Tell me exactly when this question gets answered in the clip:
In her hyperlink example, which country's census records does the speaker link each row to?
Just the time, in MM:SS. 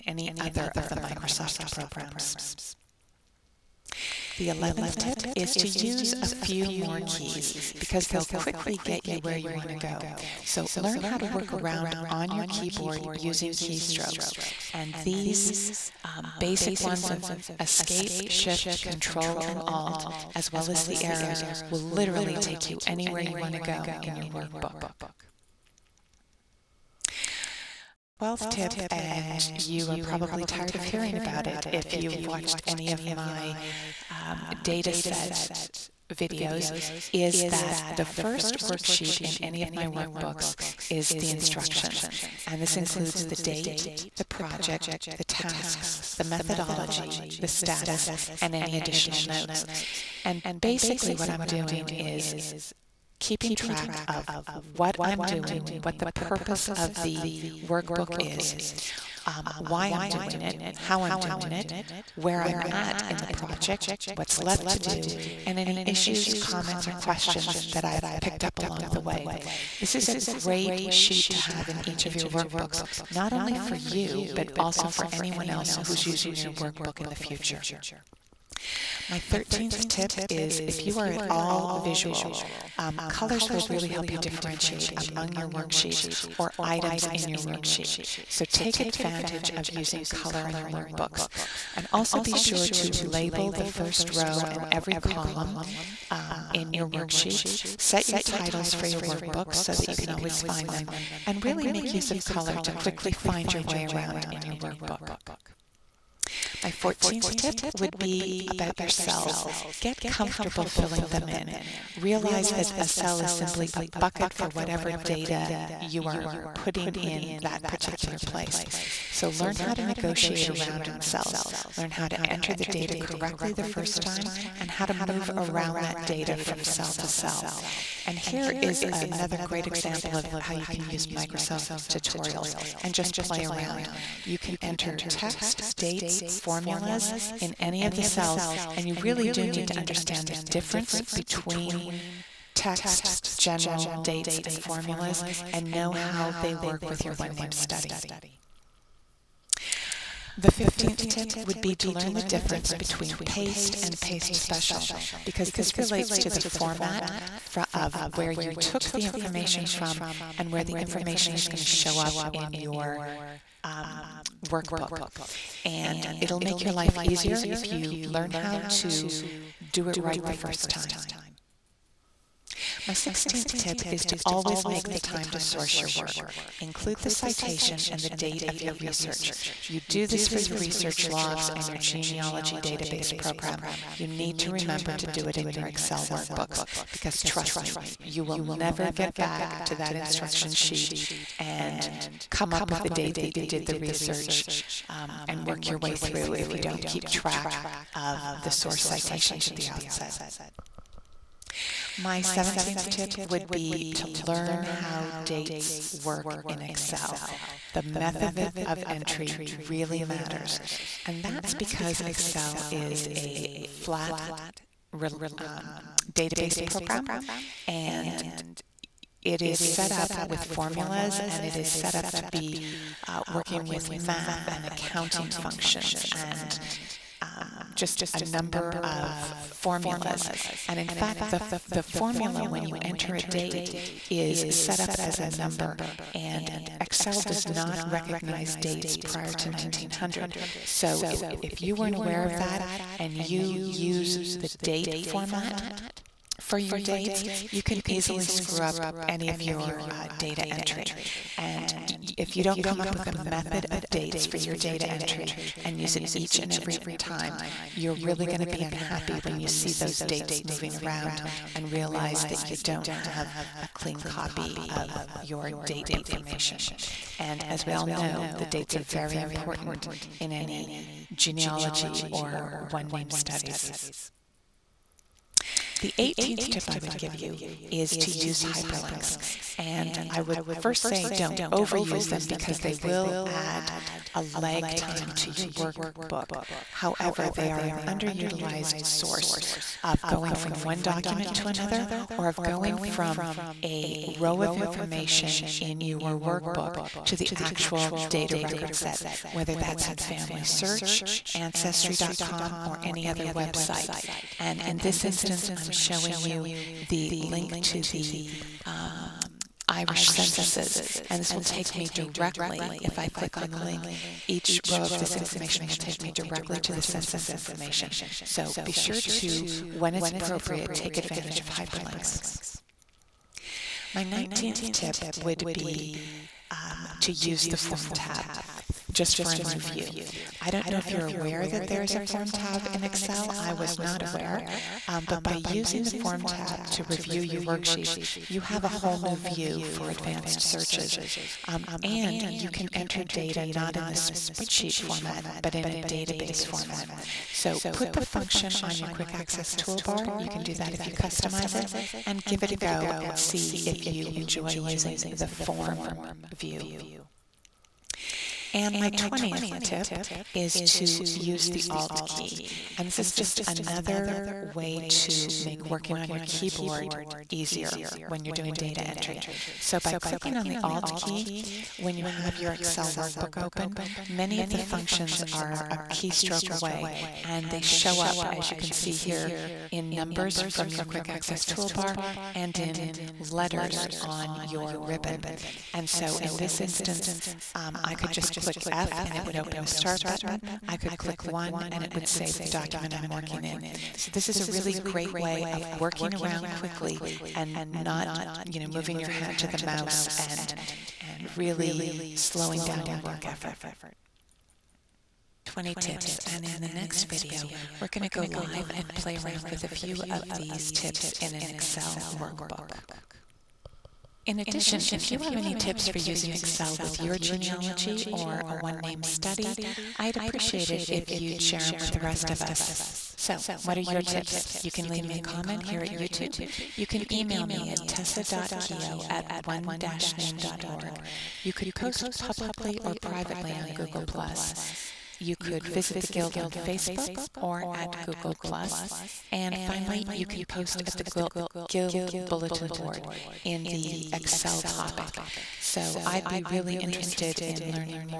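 05:09.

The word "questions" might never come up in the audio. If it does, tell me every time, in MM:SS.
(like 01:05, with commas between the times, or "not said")
01:06.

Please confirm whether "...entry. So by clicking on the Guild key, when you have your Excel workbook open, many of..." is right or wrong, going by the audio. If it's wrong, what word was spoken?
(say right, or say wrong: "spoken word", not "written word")
wrong: "Alt", not "Guild".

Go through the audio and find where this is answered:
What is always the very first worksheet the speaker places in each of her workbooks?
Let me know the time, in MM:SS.
00:41.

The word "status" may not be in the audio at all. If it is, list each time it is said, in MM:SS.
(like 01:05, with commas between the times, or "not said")
00:47.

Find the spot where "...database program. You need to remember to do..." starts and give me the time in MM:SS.
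03:02.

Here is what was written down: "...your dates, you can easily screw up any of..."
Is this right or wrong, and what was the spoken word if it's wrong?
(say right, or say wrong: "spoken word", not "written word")
right.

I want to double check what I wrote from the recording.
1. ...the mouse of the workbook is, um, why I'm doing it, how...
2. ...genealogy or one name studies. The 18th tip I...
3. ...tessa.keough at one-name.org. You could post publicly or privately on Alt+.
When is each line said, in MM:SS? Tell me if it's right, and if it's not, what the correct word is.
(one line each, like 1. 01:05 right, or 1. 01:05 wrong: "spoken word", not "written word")
1. 00:55 wrong: "purpose", not "mouse"
2. 04:31 right
3. 07:07 wrong: "Google", not "Alt".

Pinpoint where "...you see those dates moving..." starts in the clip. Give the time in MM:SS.
04:19.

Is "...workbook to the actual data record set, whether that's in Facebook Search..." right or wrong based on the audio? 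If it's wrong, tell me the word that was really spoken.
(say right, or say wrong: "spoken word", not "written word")
wrong: "Family", not "Facebook".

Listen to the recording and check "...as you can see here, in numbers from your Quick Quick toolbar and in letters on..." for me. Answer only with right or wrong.
wrong.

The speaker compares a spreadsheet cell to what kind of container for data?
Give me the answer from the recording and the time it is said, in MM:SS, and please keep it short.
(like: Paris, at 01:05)
a bucket, at 01:53.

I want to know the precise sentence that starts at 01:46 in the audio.
My 14th tip would be about your cells.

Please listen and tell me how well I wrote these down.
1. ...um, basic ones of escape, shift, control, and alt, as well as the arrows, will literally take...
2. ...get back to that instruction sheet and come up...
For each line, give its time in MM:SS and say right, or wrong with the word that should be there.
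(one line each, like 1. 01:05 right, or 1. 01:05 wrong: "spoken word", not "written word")
1. 00:16 right
2. 03:08 right.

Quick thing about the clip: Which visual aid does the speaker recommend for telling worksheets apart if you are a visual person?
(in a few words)
colors.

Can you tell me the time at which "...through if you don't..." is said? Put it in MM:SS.
03:15.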